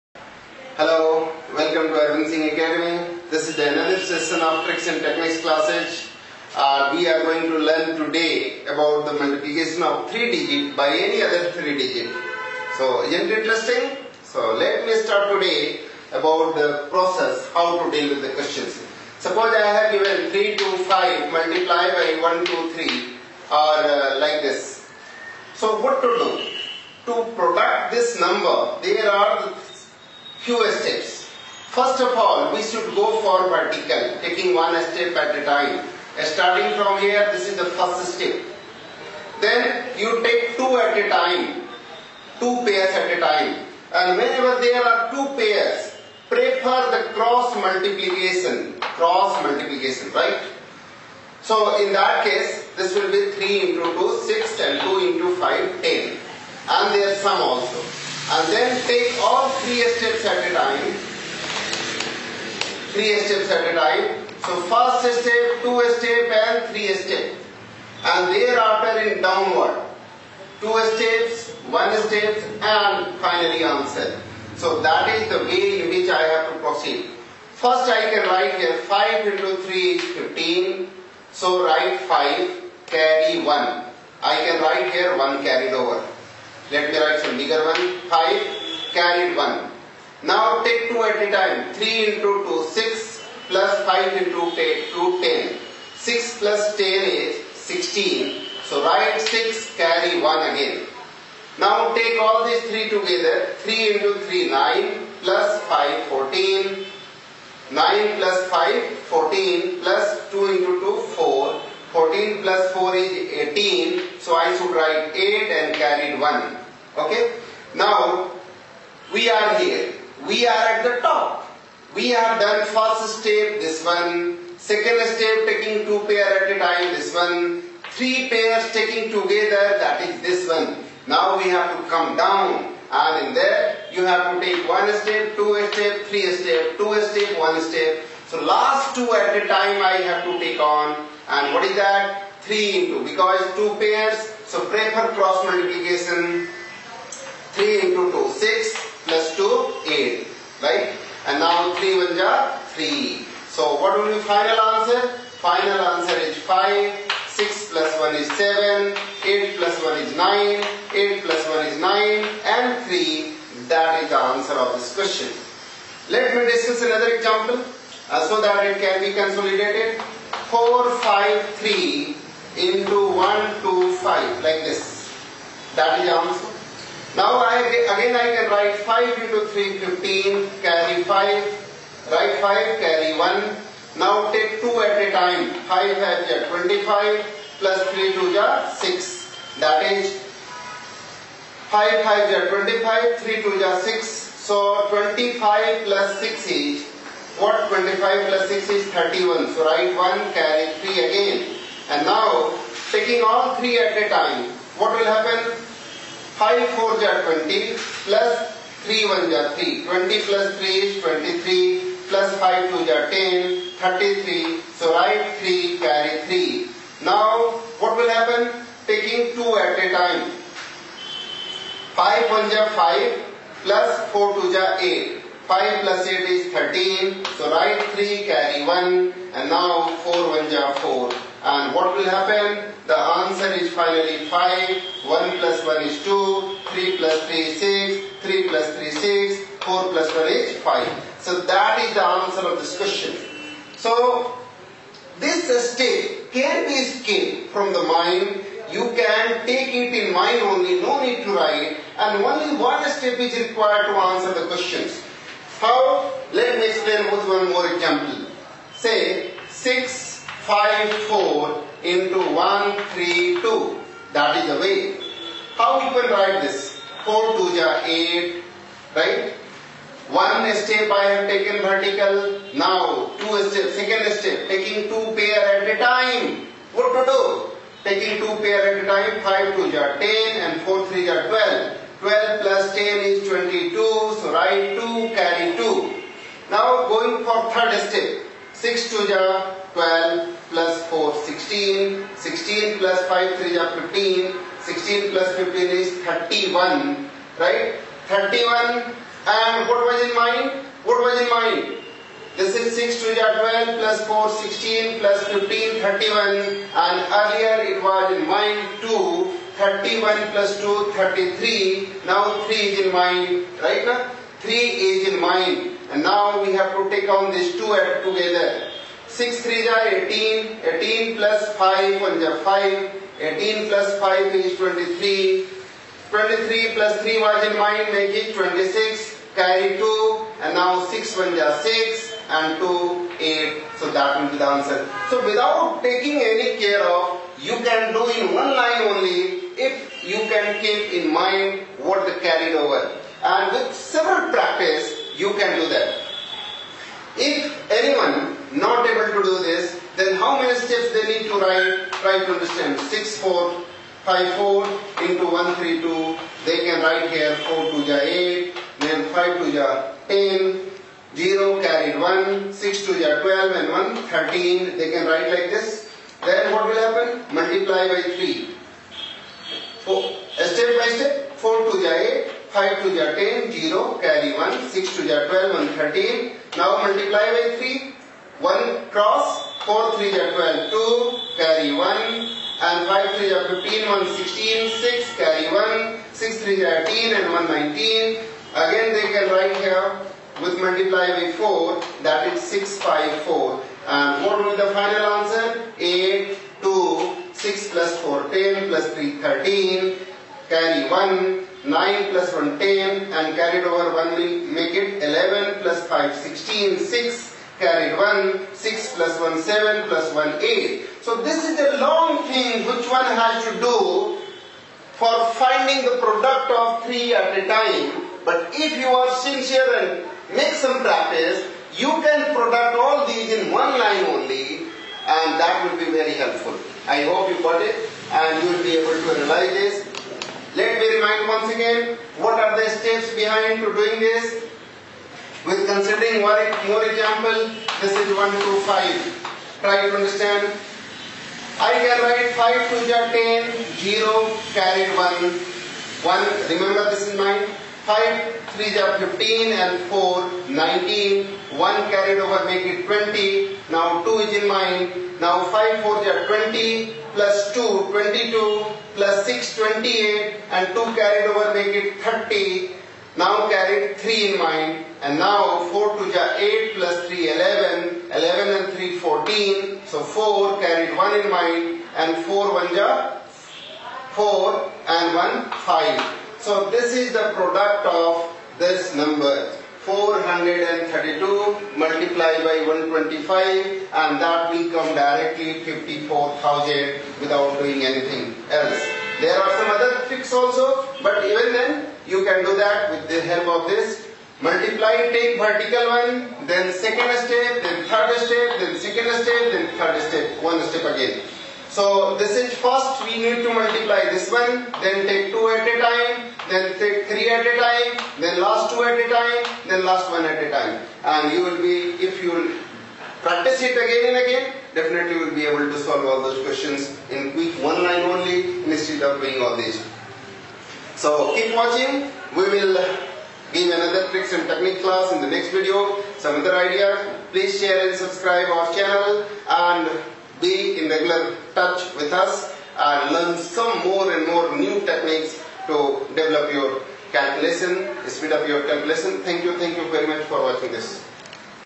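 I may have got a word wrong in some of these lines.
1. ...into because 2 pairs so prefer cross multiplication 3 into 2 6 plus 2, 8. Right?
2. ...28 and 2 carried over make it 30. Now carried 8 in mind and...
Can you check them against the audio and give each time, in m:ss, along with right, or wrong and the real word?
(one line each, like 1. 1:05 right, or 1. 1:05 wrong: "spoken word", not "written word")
1. 2:22 right
2. 7:39 wrong: "3", not "8".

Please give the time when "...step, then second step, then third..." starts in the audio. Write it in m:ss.
8:18.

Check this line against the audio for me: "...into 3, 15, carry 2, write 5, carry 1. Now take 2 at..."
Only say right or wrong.
wrong.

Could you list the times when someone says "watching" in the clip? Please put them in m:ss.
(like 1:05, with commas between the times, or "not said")
8:41, 9:00.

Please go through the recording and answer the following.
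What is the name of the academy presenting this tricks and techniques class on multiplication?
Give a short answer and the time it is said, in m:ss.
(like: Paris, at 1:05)
Sequencing Academy, at 0:02.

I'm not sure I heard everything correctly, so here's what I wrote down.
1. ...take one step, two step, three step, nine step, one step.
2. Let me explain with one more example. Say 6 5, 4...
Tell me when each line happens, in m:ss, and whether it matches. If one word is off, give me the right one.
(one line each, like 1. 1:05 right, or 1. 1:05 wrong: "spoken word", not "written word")
1. 2:14 wrong: "two", not "nine"
2. 4:16 right.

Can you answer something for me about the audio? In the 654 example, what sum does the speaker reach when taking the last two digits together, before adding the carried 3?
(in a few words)
23.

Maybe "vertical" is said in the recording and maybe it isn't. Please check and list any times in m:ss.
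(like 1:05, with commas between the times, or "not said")
0:33, 4:31, 8:15.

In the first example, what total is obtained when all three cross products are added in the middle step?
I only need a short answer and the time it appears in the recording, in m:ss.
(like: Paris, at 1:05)
18, at 1:51.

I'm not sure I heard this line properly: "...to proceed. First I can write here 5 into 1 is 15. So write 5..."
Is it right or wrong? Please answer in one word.
wrong.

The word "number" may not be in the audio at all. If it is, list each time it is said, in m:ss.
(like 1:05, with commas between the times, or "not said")
0:28, 7:58.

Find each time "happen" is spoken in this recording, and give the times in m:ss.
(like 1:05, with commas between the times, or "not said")
3:25, 3:38, 3:52, 6:06.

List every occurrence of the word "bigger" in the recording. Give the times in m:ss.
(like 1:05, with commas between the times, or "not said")
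1:27.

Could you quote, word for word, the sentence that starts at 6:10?
Step by step, 4 to the 8, 5 to the 10, 0, carry 1, 6 to the 12 and 13.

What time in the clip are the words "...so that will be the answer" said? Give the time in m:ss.
5:33.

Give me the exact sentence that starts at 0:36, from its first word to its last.
Starting from here, this is the first step.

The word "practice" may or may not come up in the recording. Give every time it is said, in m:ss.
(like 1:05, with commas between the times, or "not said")
5:44, 7:00, 8:33.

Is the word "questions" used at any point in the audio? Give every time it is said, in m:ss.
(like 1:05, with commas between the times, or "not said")
0:18, 2:44, 4:02, 4:14, 8:36.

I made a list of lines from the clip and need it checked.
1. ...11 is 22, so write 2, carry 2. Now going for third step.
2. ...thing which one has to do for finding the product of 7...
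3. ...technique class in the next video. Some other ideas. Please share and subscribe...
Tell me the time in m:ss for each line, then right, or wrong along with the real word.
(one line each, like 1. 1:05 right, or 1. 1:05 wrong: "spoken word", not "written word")
1. 4:42 wrong: "10", not "11"
2. 6:52 wrong: "3", not "7"
3. 8:44 right.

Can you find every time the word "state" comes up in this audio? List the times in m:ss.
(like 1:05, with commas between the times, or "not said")
4:05.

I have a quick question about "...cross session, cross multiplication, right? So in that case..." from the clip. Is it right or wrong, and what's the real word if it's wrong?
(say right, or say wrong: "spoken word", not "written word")
wrong: "multiplication", not "session".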